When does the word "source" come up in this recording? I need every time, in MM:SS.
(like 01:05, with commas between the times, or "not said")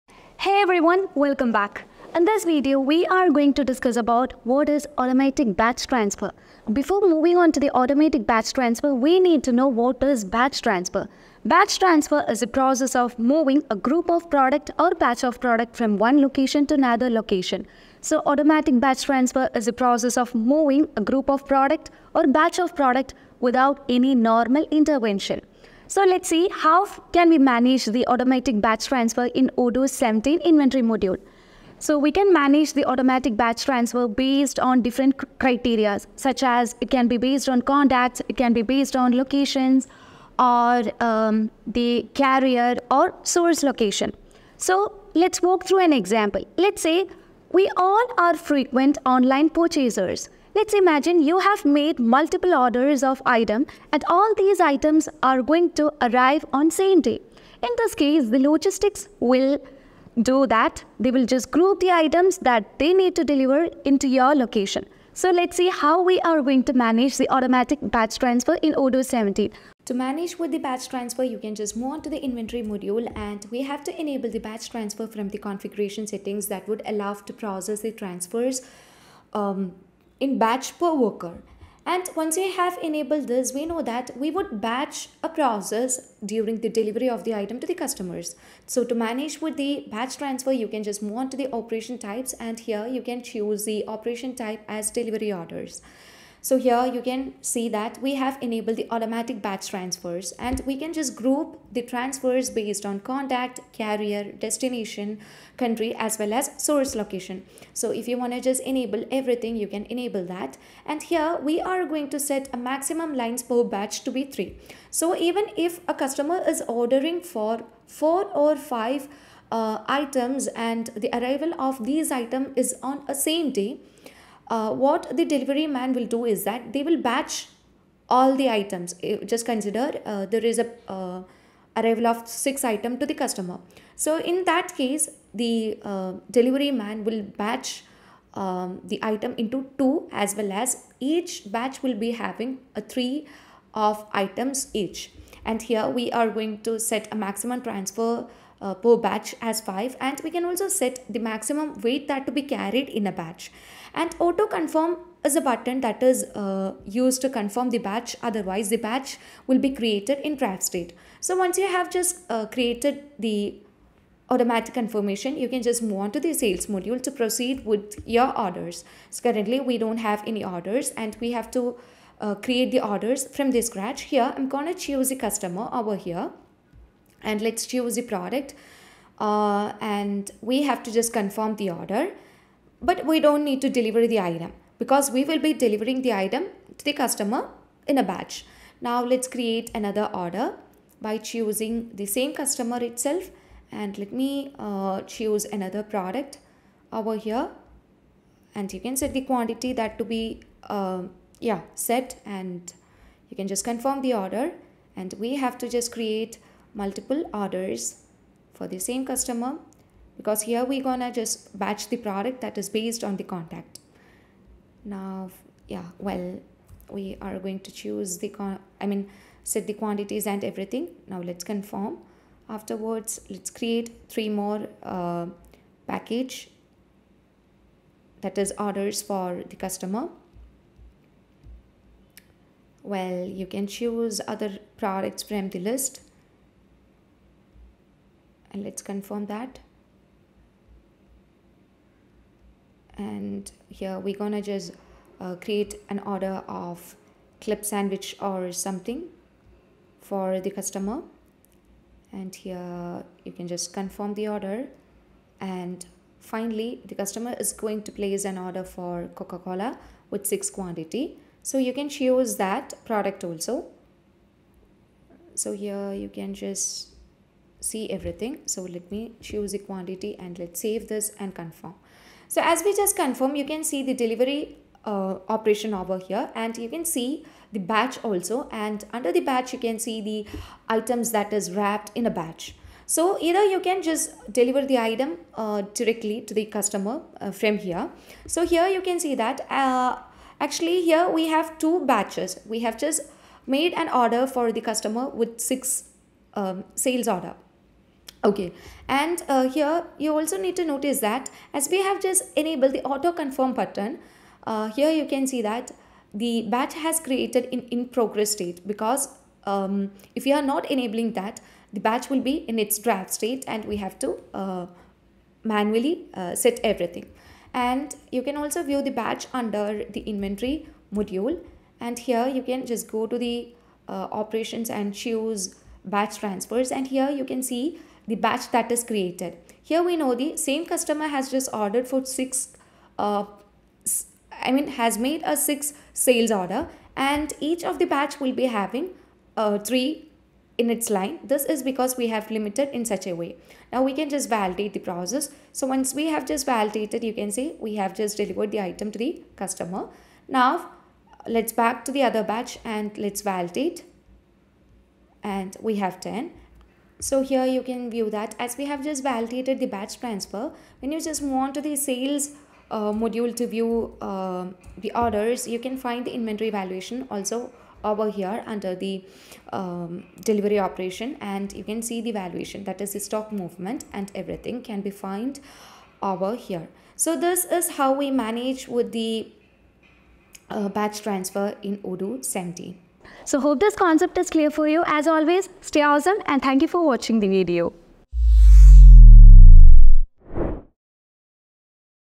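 00:43, 01:46.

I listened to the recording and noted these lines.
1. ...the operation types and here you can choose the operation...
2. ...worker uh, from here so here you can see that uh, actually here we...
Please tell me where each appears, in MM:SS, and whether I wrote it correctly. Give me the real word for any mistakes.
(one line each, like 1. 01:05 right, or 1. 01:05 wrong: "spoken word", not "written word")
1. 01:31 right
2. 04:46 wrong: "customer", not "worker".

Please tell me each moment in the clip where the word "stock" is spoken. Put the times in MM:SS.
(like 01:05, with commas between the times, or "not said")
06:12.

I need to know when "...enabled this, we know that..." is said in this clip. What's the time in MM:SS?
01:22.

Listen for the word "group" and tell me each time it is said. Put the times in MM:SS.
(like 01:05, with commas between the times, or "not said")
00:13, 00:21, 01:01, 01:41.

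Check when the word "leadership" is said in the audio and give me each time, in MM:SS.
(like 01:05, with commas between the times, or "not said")
not said.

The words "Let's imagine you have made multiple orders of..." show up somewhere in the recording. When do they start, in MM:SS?
00:50.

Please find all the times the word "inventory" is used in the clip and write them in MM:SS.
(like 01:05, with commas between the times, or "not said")
00:30, 01:12, 05:20, 06:06.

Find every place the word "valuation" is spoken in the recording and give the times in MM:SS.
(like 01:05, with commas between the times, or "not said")
06:06, 06:12.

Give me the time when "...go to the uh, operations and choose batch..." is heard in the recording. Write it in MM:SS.
05:22.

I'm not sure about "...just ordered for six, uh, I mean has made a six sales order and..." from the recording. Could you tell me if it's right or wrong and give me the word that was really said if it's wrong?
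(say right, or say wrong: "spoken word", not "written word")
right.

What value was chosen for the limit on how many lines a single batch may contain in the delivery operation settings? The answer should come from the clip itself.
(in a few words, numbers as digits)
3.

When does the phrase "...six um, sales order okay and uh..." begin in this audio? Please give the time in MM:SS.
04:55.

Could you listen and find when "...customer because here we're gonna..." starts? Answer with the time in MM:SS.
03:29.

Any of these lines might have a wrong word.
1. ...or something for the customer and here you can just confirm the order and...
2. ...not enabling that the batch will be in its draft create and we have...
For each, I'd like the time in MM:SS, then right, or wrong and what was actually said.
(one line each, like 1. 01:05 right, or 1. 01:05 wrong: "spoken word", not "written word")
1. 04:08 right
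2. 05:10 wrong: "state", not "create".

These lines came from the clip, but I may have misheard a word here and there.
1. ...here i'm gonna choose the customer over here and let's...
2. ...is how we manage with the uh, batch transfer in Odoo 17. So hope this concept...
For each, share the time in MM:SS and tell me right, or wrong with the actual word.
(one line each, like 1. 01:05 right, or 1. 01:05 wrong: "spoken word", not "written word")
1. 02:54 right
2. 06:17 right.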